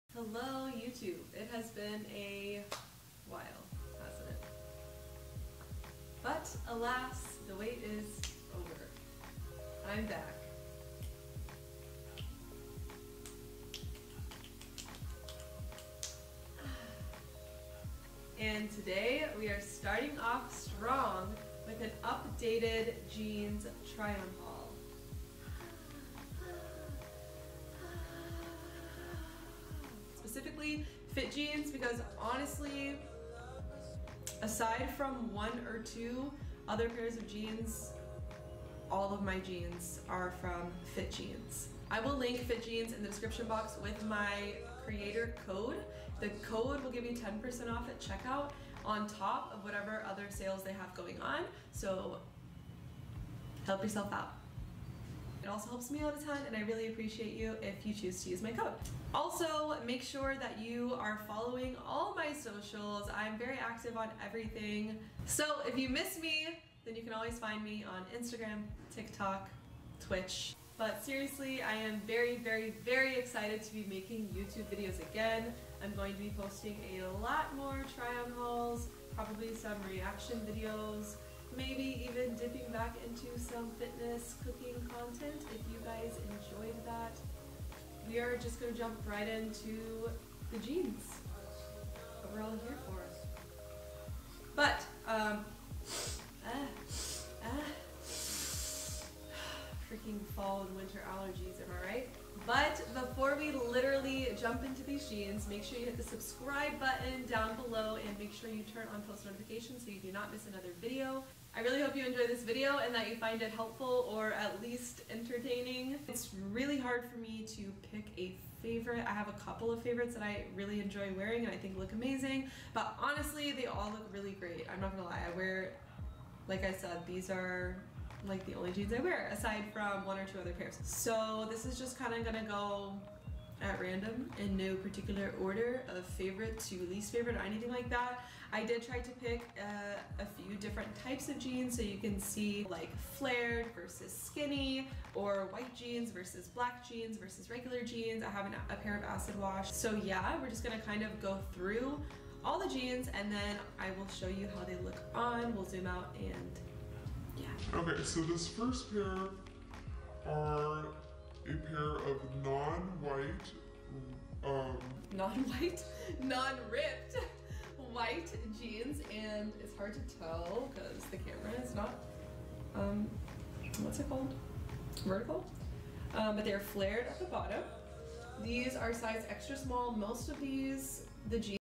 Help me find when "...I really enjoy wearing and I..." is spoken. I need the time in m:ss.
2:00.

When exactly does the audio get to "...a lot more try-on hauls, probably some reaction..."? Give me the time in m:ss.
1:16.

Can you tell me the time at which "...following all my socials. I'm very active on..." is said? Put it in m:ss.
1:01.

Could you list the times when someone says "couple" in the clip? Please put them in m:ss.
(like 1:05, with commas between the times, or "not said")
1:59.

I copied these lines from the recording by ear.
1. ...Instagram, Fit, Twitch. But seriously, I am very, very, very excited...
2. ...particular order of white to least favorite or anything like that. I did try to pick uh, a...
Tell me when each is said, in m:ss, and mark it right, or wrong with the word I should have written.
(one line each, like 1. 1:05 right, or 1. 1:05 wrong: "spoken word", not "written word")
1. 1:08 wrong: "TikTok", not "Fit"
2. 2:14 wrong: "favorite", not "white".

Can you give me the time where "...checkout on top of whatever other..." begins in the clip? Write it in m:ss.
0:48.